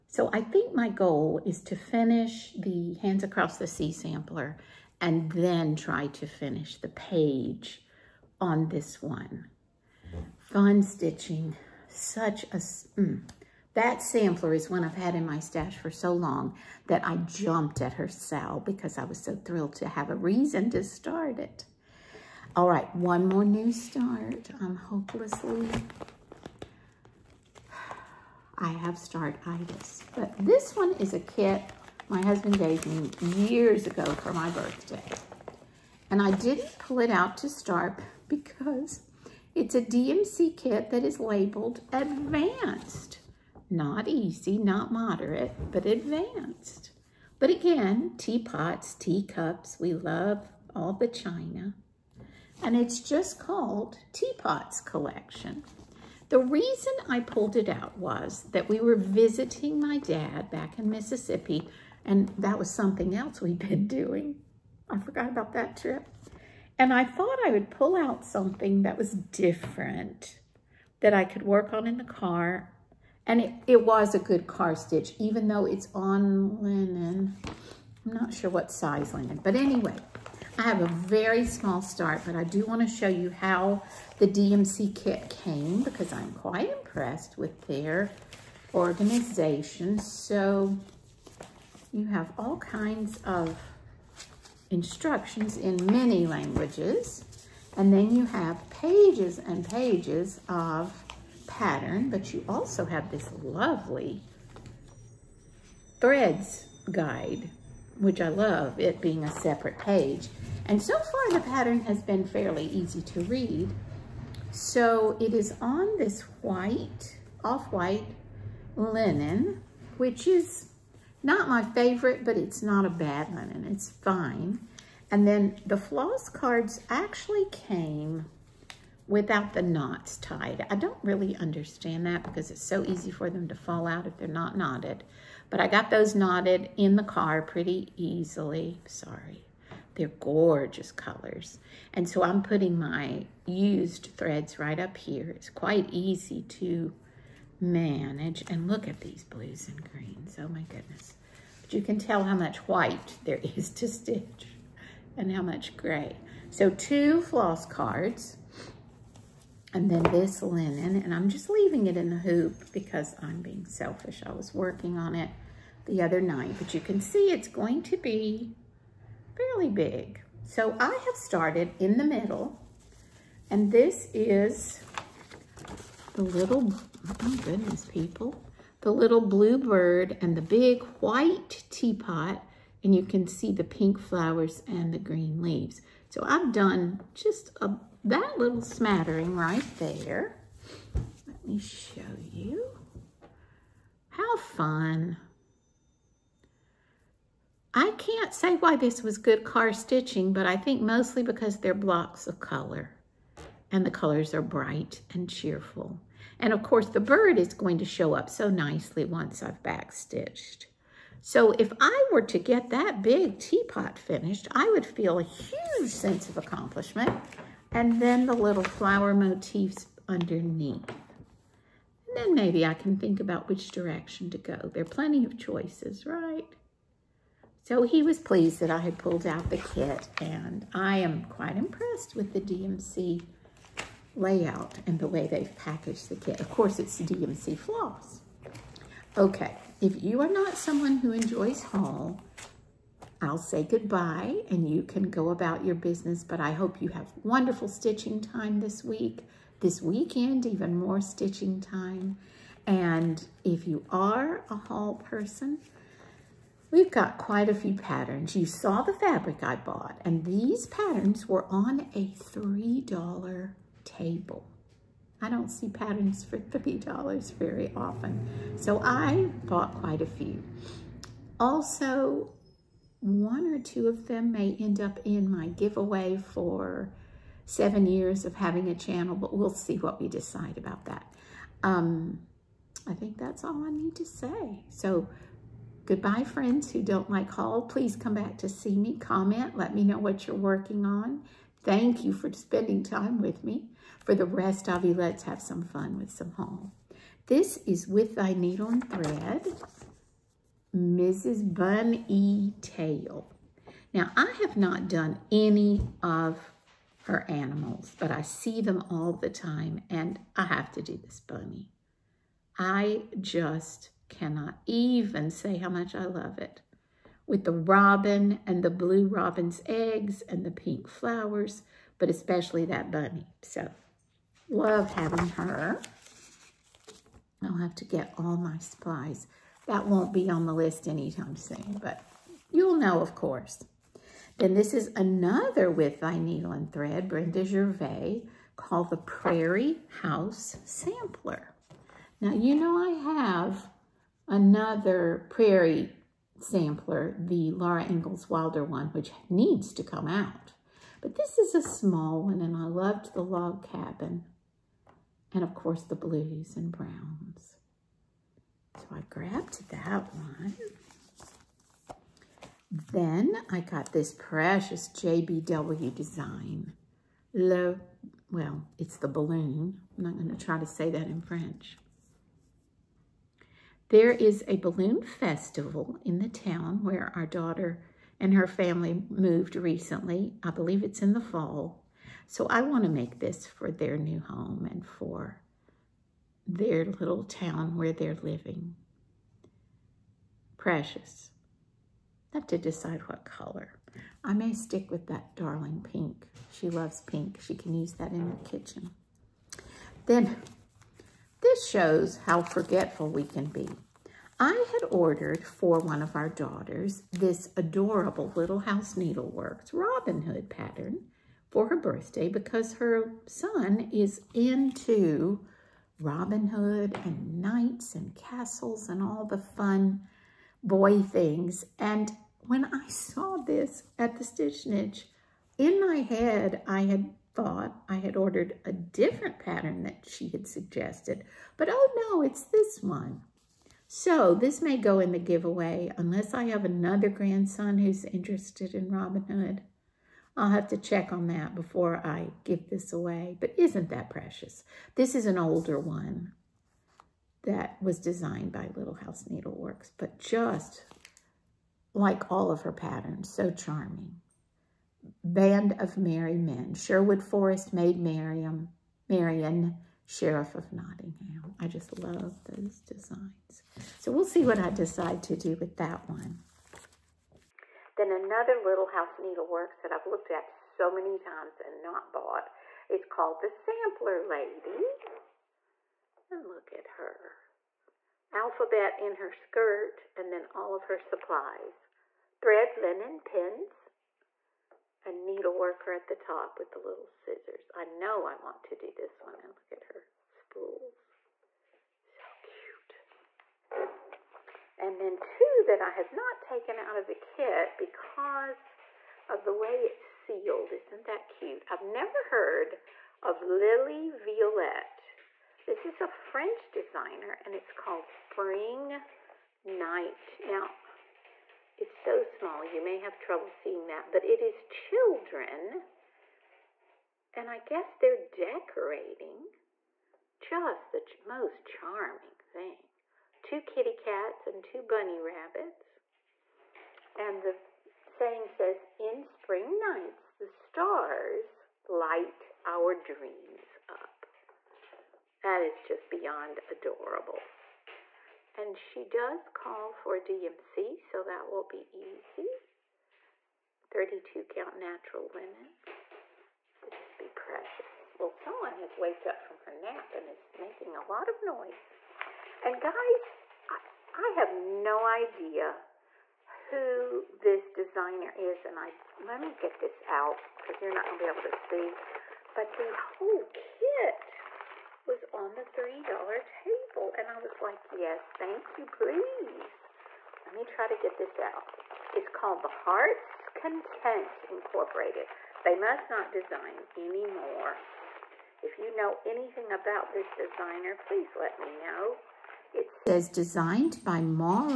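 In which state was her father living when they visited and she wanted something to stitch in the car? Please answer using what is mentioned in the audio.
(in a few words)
Mississippi.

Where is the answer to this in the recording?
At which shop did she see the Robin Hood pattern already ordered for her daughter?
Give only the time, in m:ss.
7:04.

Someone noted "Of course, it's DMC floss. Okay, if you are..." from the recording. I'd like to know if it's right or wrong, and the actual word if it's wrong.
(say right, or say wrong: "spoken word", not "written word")
right.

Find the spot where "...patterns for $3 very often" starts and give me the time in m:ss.
4:25.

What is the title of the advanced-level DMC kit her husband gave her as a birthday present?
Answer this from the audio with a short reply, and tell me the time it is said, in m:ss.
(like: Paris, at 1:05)
Teapots Collection, at 0:54.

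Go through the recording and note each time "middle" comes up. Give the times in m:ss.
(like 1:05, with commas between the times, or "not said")
2:52.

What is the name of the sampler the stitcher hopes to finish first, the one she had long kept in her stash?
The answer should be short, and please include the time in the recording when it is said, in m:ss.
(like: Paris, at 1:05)
Hands Across the Sea, at 0:03.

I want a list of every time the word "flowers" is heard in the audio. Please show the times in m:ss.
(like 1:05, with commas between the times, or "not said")
3:03, 3:38, 5:20.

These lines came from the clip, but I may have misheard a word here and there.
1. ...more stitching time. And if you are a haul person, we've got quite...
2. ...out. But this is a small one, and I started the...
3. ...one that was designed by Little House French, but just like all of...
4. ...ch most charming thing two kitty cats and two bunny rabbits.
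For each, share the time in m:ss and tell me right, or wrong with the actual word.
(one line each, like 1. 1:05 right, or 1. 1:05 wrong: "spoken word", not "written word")
1. 4:10 right
2. 5:50 wrong: "loved", not "started"
3. 7:25 wrong: "Needleworks", not "French"
4. 8:40 right.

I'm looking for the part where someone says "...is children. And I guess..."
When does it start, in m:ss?
8:34.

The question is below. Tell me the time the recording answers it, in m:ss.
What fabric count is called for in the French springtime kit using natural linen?
9:03.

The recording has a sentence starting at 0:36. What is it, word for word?
And I didn't pull it out to start because it's a DMC kit that is labeled advanced.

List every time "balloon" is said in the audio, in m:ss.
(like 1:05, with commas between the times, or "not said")
6:09, 6:14.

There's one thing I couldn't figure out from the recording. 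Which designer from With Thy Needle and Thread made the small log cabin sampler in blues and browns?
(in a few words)
Brenda Gervais.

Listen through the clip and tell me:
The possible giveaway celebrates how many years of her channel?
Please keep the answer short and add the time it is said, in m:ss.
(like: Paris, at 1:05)
7, at 4:37.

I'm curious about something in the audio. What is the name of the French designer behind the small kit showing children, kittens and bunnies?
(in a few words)
Lili Violette.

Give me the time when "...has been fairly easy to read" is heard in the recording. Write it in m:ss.
1:51.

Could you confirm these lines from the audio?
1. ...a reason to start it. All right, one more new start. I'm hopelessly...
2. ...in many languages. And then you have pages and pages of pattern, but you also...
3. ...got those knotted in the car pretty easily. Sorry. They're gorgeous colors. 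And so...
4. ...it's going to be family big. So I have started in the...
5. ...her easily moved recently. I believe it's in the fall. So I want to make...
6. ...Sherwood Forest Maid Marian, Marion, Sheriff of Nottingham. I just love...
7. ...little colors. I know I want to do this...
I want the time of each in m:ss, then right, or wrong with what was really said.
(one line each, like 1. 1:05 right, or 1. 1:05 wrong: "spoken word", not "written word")
1. 0:20 right
2. 1:35 right
3. 2:15 right
4. 2:47 wrong: "fairly", not "family"
5. 6:18 wrong: "family", not "easily"
6. 7:36 right
7. 8:06 wrong: "scissors", not "colors".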